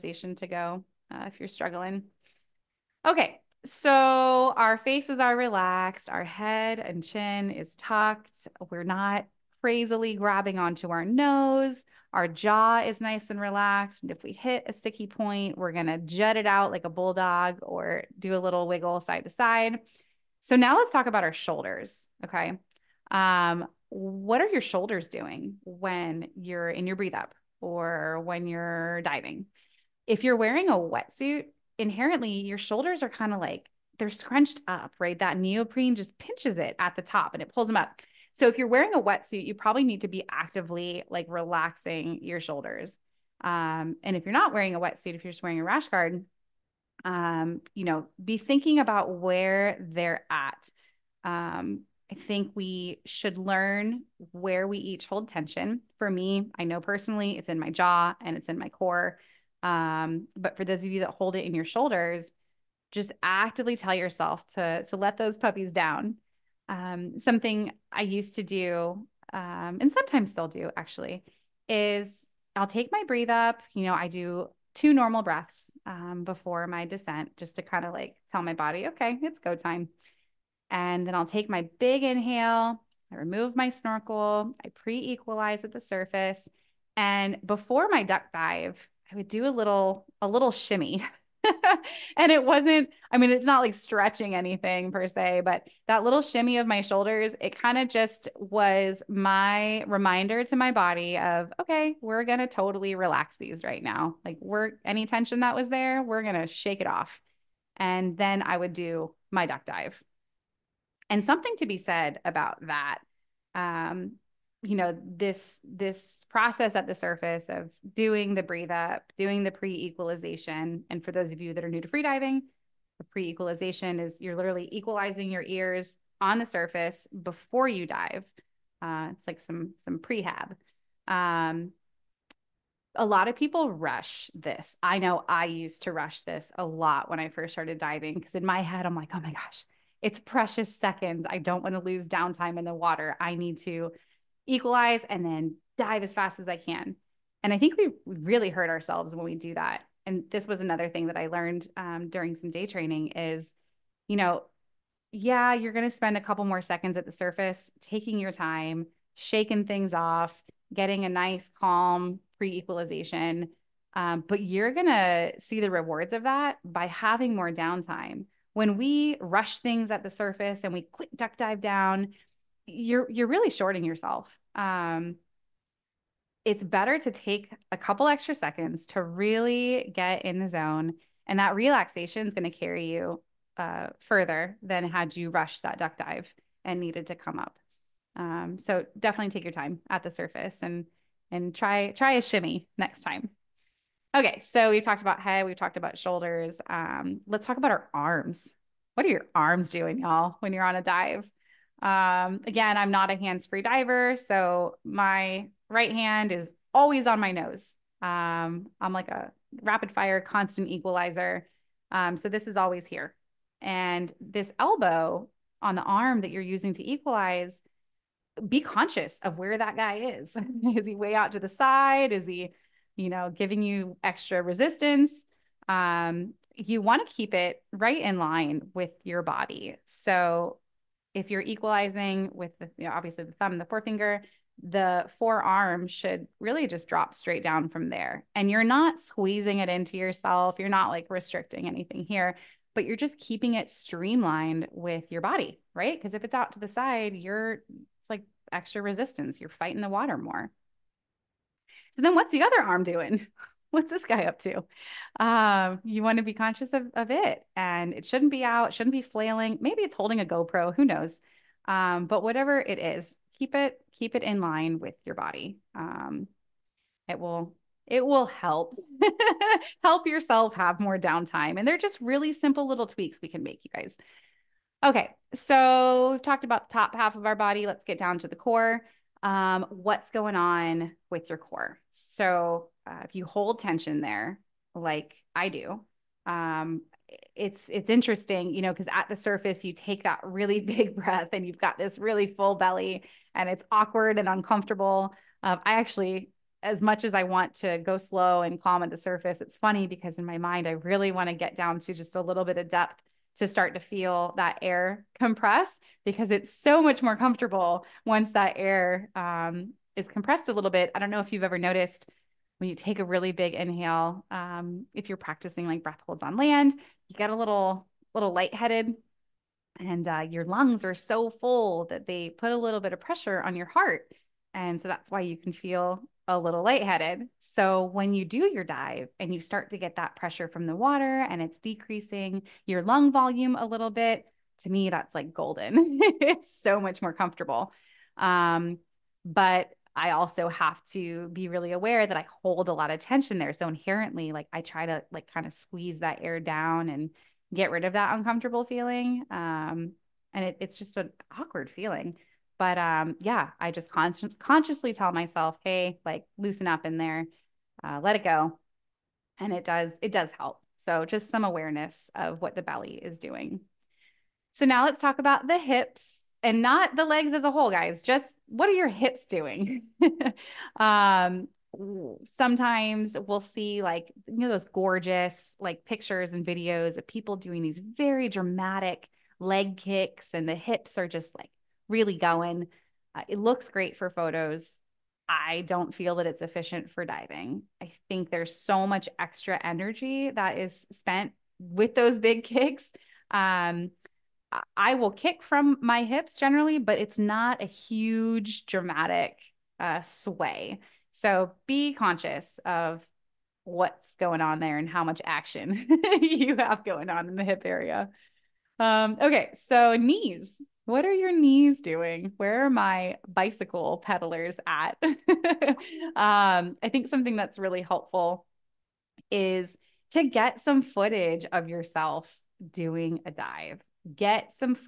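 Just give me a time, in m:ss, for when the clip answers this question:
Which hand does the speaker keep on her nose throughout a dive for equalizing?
3:24.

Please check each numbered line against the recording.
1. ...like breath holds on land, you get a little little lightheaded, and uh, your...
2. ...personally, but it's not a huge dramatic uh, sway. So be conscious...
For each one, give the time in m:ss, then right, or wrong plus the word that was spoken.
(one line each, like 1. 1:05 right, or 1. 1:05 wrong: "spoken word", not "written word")
1. 5:15 right
2. 6:36 wrong: "generally", not "personally".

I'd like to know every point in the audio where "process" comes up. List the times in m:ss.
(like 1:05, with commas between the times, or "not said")
1:56.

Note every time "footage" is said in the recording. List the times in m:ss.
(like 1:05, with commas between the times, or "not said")
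7:00.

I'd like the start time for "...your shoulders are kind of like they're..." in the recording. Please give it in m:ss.
0:32.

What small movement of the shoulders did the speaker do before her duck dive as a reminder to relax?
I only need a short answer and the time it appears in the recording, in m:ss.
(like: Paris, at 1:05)
A shimmy, at 1:30.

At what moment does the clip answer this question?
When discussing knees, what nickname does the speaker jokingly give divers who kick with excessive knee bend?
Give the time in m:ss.
6:53.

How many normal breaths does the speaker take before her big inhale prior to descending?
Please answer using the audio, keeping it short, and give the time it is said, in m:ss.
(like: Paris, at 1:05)
2, at 1:14.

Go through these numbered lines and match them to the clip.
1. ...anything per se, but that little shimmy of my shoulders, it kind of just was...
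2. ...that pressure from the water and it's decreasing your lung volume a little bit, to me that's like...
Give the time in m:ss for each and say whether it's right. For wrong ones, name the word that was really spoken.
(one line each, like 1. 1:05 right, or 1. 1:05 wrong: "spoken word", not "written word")
1. 1:34 right
2. 5:29 right.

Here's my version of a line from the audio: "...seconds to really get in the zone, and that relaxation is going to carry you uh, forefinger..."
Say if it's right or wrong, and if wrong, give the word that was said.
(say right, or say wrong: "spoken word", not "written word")
wrong: "further", not "forefinger".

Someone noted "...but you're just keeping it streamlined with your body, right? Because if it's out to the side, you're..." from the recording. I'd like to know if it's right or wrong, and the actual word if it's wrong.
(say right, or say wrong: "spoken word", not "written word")
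right.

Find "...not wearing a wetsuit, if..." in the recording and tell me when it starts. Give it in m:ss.
0:44.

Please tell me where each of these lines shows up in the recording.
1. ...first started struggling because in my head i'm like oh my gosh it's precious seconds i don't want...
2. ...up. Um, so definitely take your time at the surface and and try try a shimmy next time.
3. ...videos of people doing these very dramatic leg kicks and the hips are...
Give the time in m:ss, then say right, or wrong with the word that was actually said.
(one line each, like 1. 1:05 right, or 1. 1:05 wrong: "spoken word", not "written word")
1. 2:17 wrong: "diving", not "struggling"
2. 3:07 right
3. 6:16 right.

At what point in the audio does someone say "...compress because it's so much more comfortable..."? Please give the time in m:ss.
5:05.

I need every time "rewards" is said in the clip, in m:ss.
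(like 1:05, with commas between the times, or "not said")
2:45.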